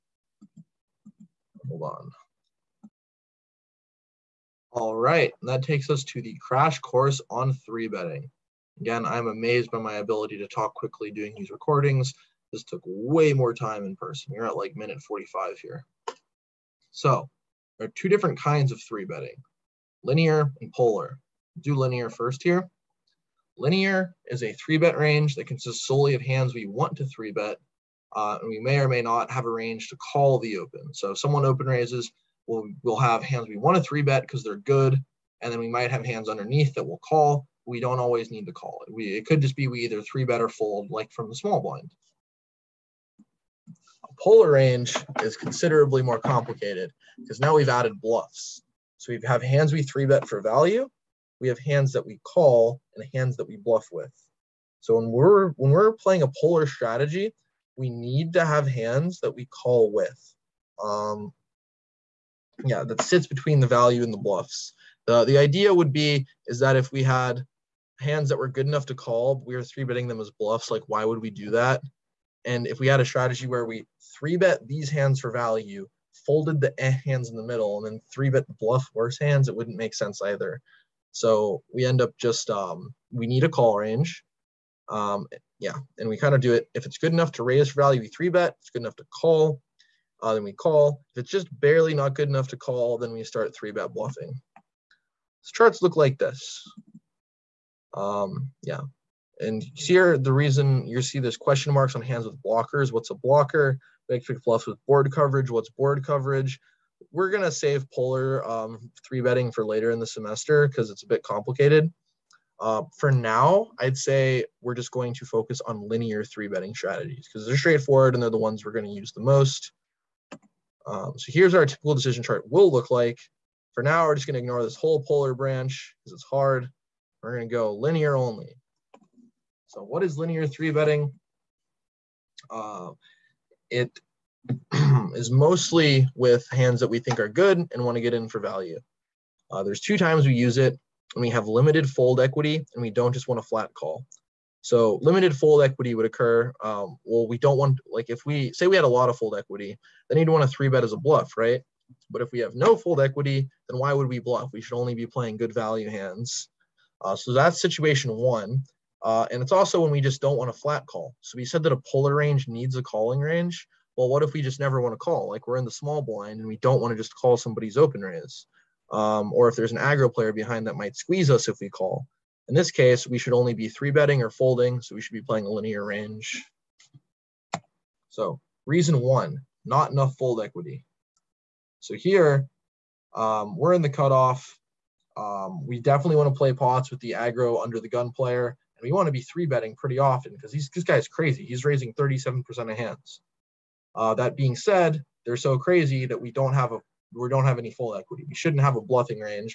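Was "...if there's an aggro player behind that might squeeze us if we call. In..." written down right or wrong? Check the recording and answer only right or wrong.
right.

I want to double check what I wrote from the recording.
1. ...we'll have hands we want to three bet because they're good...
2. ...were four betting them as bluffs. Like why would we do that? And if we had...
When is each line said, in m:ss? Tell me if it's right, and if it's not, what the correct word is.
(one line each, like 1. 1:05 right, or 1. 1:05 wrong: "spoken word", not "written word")
1. 0:32 right
2. 1:09 wrong: "three", not "four".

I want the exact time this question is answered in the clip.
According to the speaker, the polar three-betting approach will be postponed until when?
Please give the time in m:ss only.
1:49.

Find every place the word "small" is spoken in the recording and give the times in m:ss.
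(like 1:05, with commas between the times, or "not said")
0:41, 2:45.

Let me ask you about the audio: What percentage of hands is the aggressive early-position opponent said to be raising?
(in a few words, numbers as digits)
37%.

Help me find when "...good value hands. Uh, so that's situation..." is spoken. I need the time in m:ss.
2:35.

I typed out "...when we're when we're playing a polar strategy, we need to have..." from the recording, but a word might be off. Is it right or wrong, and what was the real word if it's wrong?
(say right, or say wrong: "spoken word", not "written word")
right.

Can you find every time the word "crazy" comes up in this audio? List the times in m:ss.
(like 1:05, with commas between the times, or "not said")
3:11, 3:15.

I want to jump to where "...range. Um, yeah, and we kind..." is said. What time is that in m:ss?
1:23.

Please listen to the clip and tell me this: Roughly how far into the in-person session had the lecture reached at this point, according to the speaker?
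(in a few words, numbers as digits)
minute 45.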